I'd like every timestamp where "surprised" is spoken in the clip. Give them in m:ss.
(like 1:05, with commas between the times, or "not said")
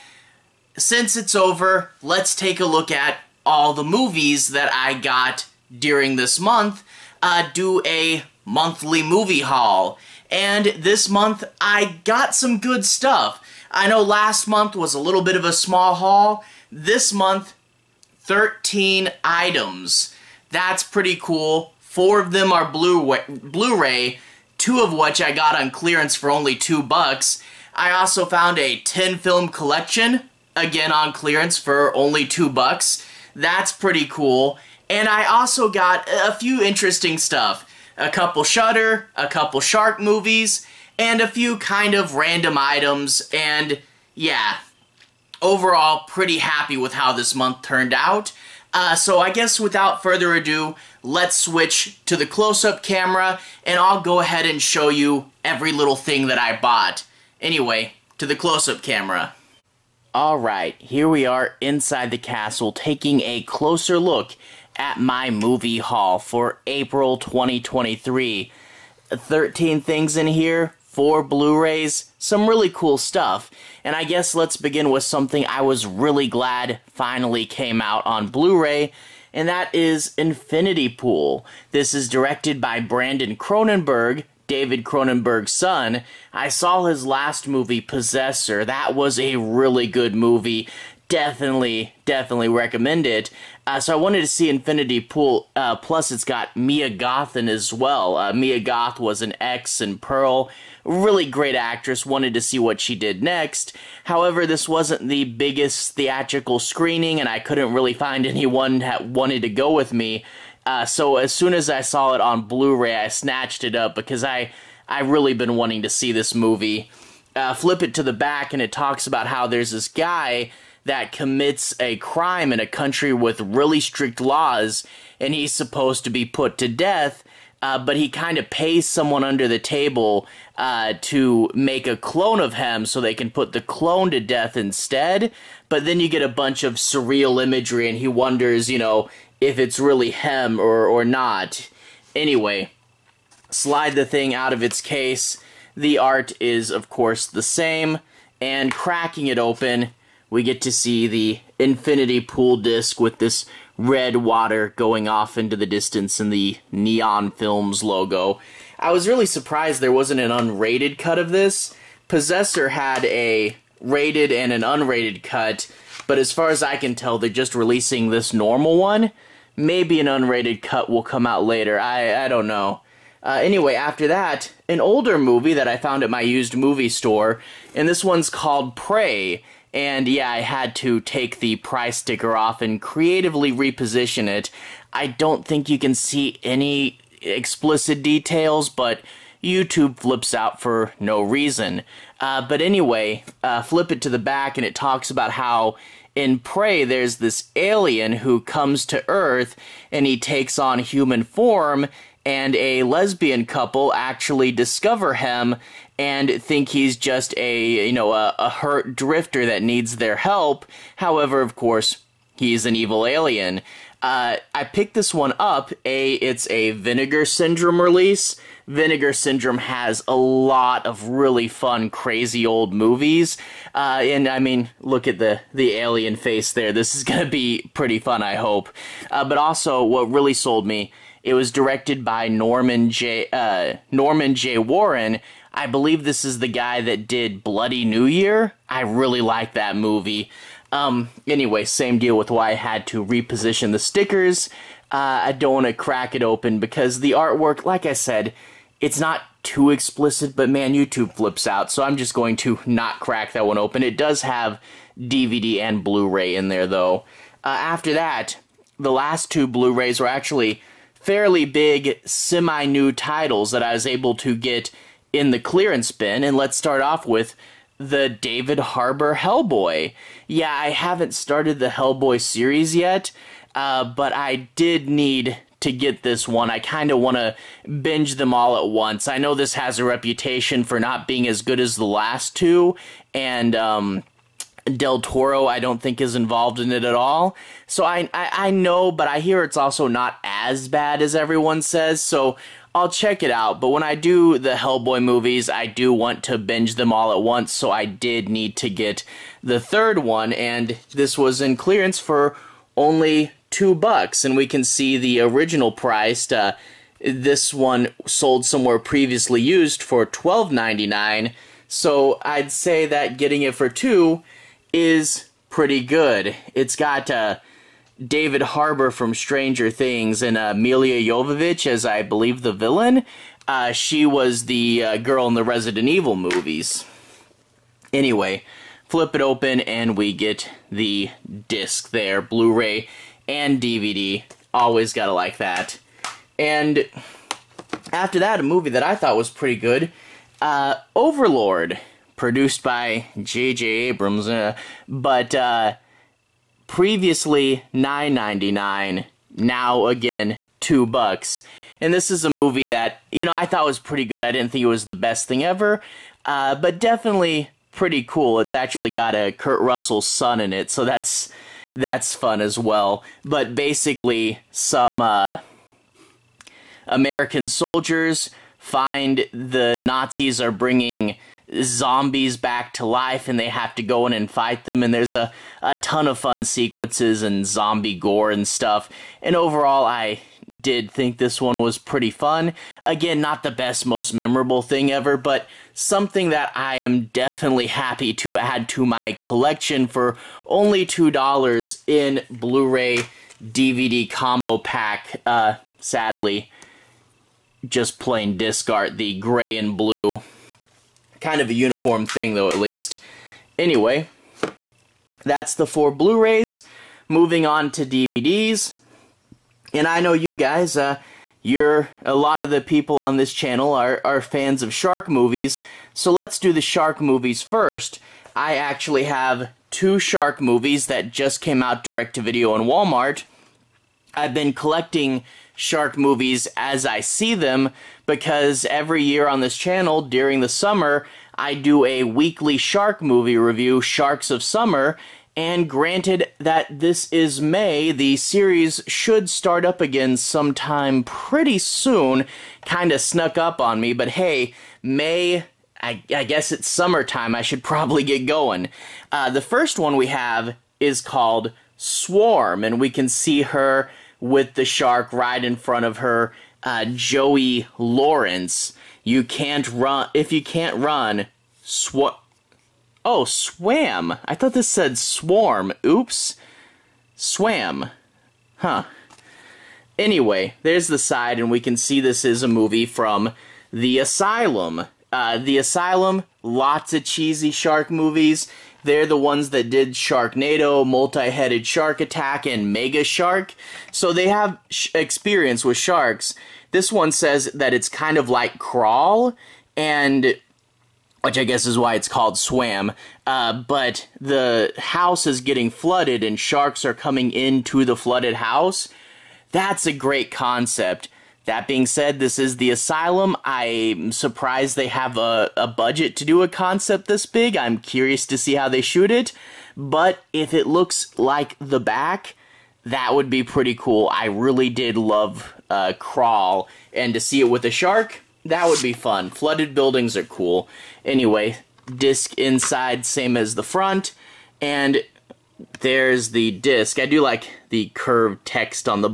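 2:39, 8:24.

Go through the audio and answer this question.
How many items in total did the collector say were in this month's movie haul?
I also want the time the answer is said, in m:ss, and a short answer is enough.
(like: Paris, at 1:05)
13, at 0:18.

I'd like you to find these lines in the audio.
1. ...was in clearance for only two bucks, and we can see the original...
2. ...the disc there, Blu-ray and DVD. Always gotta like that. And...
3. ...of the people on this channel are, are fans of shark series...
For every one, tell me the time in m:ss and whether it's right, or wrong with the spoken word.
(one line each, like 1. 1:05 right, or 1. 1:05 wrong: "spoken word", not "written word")
1. 5:01 right
2. 5:30 right
3. 6:52 wrong: "movies", not "series".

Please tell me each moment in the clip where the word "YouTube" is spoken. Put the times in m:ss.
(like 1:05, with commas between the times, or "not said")
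3:09, 4:10.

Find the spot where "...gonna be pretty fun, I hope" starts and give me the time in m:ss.
3:47.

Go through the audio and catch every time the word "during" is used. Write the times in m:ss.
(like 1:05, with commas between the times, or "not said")
0:05, 7:10.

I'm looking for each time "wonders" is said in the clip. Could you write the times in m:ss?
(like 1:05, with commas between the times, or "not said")
2:18.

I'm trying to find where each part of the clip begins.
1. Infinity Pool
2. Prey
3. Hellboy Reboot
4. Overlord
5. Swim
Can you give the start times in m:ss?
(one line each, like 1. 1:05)
1. 0:59
2. 2:52
3. 4:16
4. 5:35
5. 6:48.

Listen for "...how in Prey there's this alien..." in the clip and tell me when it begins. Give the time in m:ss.
3:15.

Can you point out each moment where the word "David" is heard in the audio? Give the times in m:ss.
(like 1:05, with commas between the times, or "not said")
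1:24, 4:28, 5:18.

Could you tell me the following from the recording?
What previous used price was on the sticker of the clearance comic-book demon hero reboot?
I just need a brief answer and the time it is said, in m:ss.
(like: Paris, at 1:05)
$12.99, at 5:10.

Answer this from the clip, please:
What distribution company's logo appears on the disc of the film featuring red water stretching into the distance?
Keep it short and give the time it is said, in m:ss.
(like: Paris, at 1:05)
Neon Films, at 2:36.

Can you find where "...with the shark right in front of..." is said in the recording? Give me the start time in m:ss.
7:34.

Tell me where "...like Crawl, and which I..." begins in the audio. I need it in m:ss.
8:08.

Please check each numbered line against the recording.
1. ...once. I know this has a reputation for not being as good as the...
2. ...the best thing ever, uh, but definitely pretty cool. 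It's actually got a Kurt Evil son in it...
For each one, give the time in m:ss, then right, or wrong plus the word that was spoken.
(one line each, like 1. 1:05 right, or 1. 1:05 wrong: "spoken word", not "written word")
1. 4:38 right
2. 5:54 wrong: "Russell", not "Evil".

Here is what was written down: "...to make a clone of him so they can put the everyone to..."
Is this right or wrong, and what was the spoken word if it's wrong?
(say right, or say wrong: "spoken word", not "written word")
wrong: "clone", not "everyone".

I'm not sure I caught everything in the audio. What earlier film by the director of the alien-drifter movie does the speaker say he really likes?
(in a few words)
Bloody New Year.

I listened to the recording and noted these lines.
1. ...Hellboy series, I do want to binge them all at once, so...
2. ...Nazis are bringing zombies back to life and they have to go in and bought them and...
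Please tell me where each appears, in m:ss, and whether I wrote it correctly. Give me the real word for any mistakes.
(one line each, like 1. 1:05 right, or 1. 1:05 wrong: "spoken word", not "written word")
1. 4:54 wrong: "movies", not "series"
2. 6:09 wrong: "fight", not "bought".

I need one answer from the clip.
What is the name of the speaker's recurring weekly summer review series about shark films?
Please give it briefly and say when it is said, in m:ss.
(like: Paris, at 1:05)
Sharks of Summer, at 7:13.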